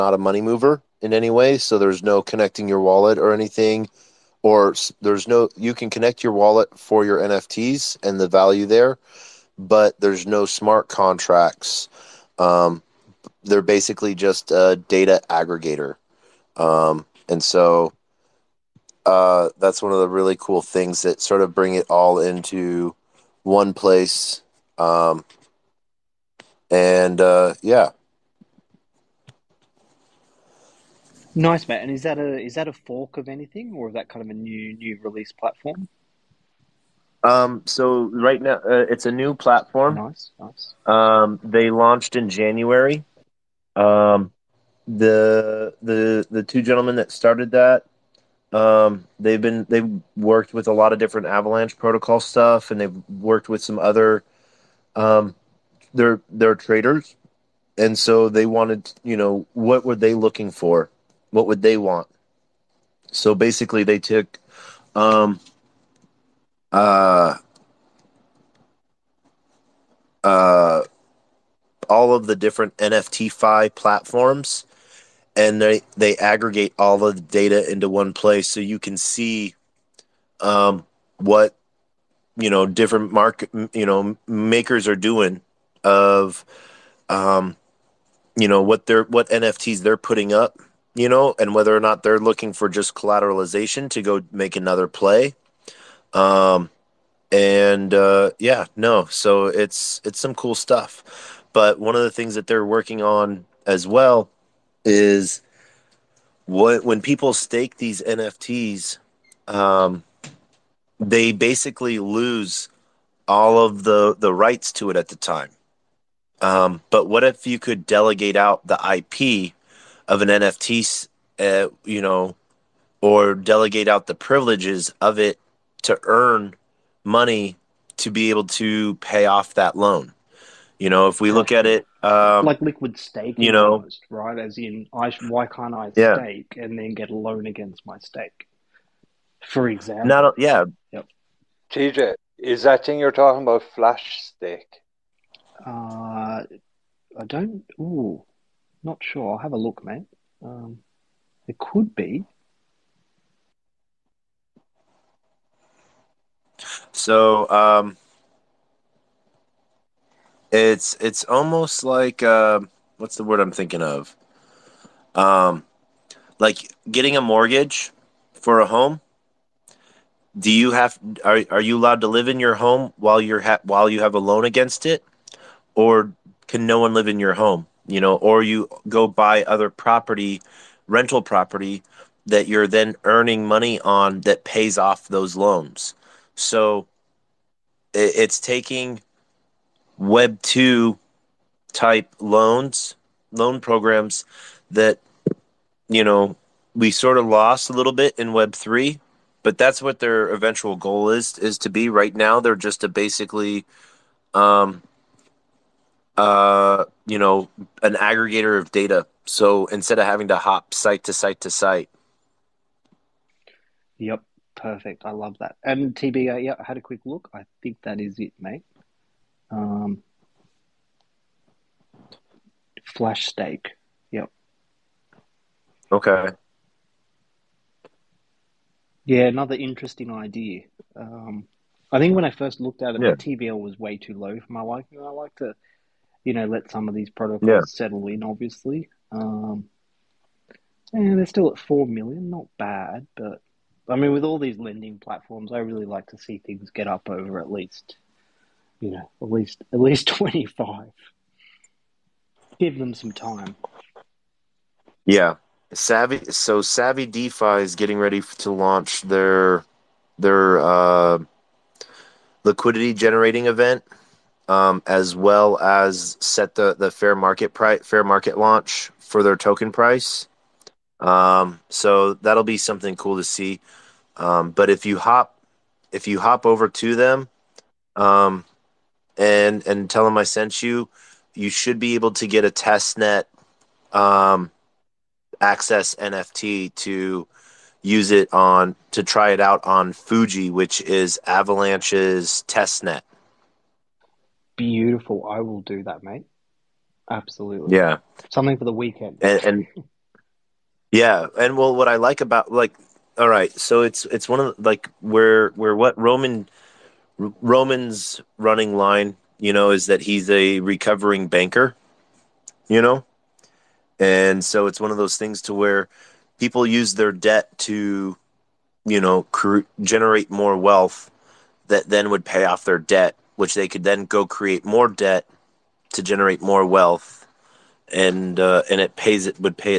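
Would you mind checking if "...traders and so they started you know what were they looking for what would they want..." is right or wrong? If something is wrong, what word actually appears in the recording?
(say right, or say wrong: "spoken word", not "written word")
wrong: "wanted", not "started".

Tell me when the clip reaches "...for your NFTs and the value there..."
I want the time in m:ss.
0:06.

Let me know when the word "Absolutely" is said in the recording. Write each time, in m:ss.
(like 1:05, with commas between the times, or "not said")
4:57.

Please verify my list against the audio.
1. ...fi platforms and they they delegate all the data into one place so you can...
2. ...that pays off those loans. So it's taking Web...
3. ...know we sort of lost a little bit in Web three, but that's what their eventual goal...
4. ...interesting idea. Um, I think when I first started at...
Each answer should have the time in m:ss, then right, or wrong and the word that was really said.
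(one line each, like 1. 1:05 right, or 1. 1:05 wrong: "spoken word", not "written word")
1. 1:13 wrong: "aggregate", not "delegate"
2. 3:04 right
3. 3:16 right
4. 3:49 wrong: "looked", not "started".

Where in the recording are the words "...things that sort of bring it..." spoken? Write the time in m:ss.
0:20.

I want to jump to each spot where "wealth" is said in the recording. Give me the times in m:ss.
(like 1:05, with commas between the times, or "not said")
5:20, 5:26.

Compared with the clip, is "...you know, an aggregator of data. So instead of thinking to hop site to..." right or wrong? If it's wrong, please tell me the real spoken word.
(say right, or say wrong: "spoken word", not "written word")
wrong: "having", not "thinking".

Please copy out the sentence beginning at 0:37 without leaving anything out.
Um, so right now uh, it's a new platform.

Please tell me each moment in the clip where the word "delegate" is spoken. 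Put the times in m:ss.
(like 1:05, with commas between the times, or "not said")
1:57, 2:03.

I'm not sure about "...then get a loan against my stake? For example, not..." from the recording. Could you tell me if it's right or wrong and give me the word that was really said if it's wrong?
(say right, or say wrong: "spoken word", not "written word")
right.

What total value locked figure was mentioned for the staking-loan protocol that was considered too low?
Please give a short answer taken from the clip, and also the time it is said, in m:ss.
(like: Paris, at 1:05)
4 million, at 4:01.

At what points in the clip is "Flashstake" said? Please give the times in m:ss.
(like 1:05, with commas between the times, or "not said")
2:23, 3:42.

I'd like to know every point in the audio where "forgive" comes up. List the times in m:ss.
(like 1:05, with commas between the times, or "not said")
not said.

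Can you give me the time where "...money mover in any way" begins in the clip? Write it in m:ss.
0:00.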